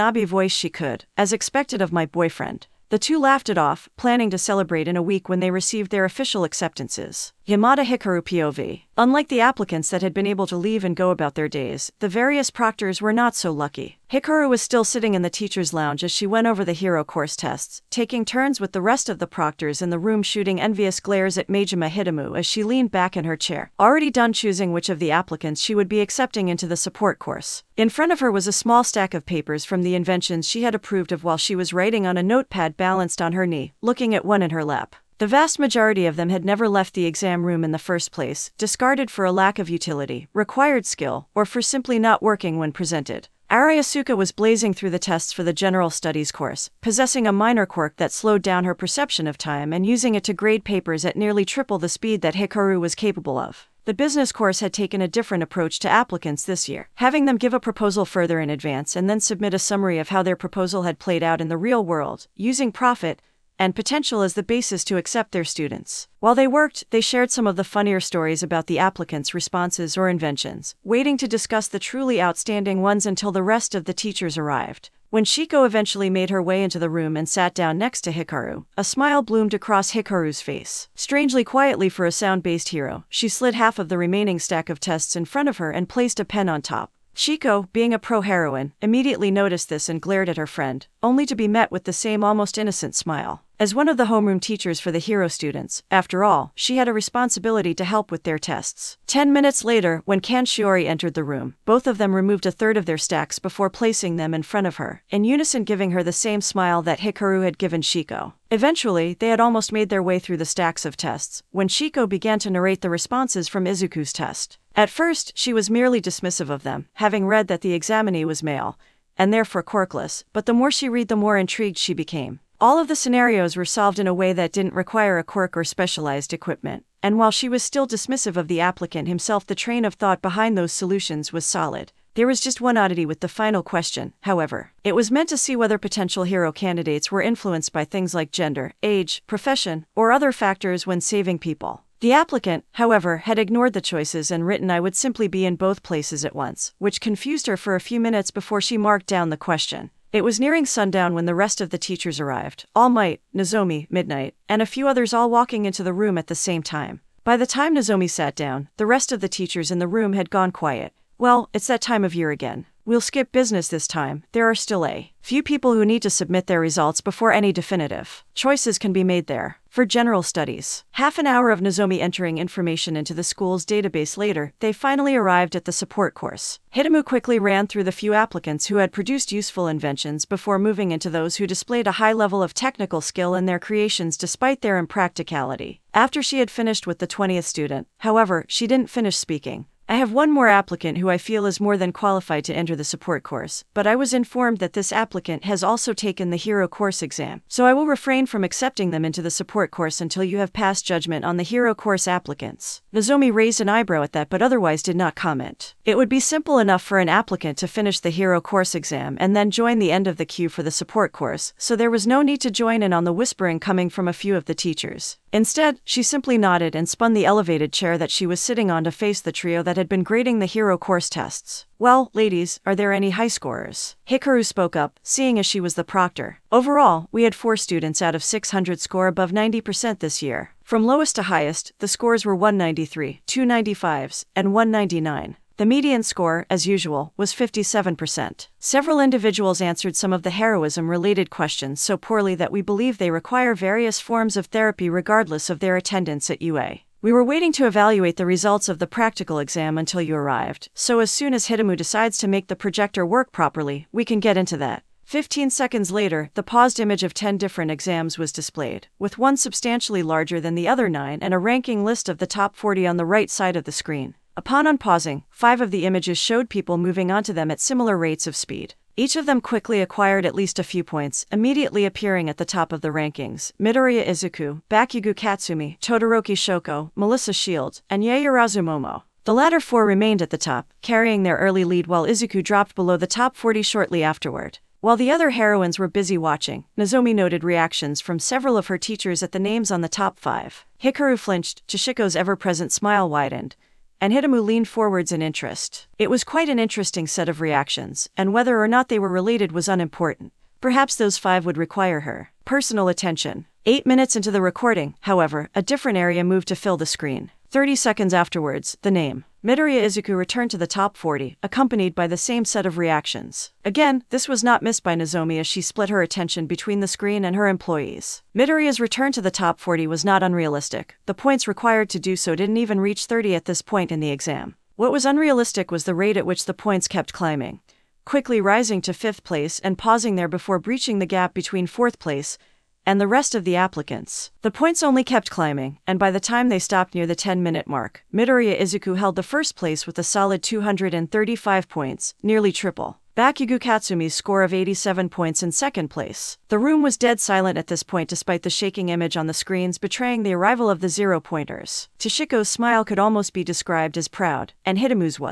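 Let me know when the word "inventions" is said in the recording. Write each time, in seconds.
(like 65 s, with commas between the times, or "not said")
29 s, 70 s, 179 s.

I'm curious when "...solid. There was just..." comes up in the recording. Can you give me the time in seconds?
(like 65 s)
131 s.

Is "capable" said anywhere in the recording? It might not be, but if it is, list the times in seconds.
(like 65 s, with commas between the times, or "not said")
52 s.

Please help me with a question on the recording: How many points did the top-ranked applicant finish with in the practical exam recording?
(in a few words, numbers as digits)
235.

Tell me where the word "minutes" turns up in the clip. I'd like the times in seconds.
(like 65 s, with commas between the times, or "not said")
99 s, 148 s, 303 s, 337 s.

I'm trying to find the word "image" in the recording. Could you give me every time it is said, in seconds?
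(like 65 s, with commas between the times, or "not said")
256 s, 265 s, 348 s.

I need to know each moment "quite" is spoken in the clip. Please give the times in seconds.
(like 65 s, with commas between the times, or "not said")
296 s.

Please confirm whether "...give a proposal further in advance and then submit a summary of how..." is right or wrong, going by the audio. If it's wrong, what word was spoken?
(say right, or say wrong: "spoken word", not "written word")
right.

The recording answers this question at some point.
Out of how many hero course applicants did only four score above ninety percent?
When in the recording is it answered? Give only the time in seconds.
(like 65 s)
228 s.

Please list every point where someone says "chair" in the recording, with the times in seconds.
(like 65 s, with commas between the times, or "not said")
23 s, 217 s.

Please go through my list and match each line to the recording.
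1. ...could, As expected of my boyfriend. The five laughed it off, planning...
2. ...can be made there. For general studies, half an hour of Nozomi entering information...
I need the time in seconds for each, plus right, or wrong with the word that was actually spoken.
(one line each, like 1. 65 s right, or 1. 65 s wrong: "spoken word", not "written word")
1. 0 s wrong: "two", not "five"
2. 168 s right.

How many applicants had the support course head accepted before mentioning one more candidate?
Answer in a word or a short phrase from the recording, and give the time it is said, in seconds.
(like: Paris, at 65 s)
20, at 187 s.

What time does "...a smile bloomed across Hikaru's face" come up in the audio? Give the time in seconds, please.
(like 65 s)
78 s.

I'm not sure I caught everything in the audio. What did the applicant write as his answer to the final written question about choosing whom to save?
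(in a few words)
be in both places at once.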